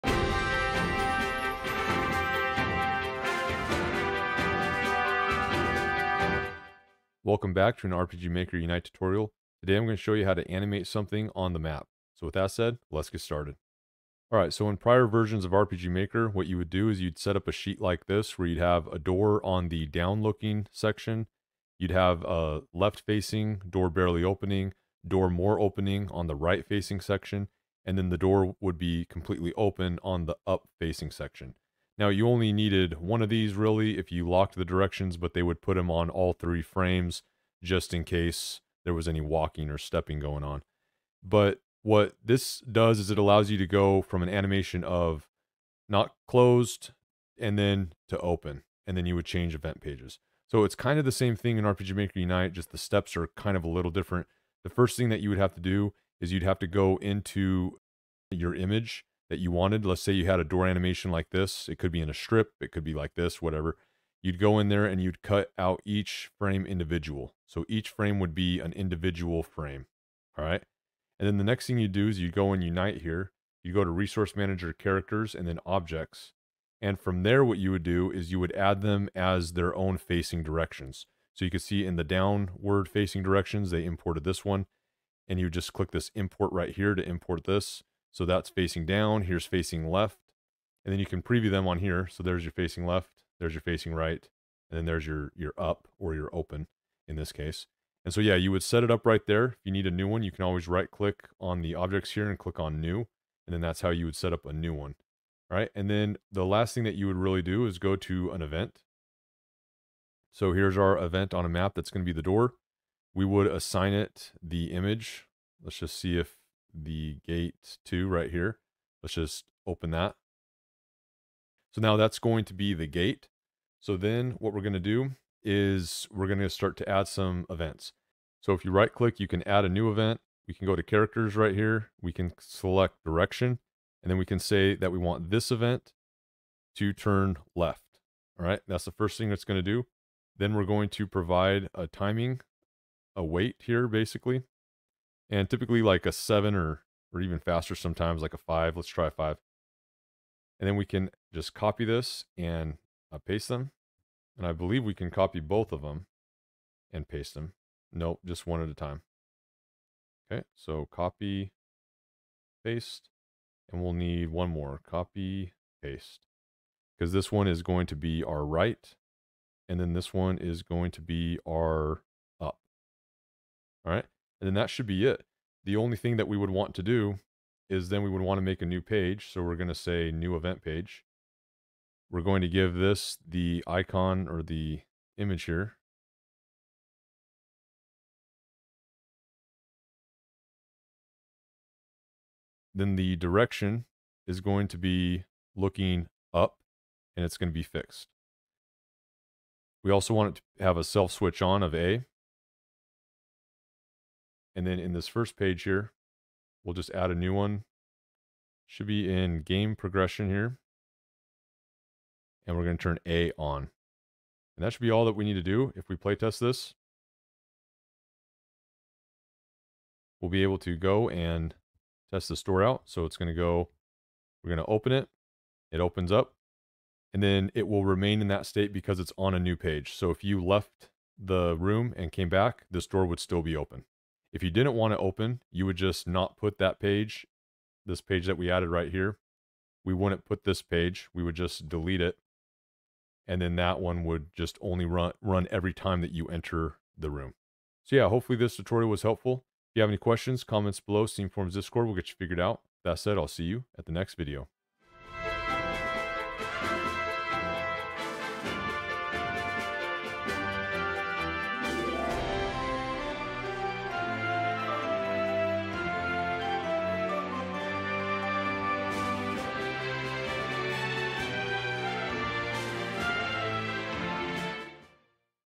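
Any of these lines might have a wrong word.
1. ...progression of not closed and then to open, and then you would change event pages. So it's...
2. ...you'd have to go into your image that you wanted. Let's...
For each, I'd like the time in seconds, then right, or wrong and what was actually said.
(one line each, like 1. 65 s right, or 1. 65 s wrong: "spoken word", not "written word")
1. 44 s wrong: "animation", not "progression"
2. 56 s right.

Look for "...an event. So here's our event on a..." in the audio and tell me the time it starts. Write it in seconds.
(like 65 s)
108 s.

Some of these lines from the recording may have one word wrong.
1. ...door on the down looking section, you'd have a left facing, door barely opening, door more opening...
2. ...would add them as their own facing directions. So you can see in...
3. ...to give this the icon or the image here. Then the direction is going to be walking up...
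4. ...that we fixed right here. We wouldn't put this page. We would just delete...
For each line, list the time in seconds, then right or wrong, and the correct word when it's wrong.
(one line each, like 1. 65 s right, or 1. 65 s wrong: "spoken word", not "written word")
1. 18 s right
2. 78 s right
3. 182 s wrong: "looking", not "walking"
4. 238 s wrong: "added", not "fixed".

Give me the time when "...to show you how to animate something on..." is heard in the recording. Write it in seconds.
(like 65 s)
9 s.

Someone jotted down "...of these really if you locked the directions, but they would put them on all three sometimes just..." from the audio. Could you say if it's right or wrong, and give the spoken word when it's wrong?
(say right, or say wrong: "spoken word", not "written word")
wrong: "frames", not "sometimes".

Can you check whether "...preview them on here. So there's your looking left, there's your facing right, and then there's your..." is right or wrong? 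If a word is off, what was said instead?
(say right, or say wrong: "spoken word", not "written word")
wrong: "facing", not "looking".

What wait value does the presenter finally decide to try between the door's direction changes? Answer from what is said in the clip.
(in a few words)
5.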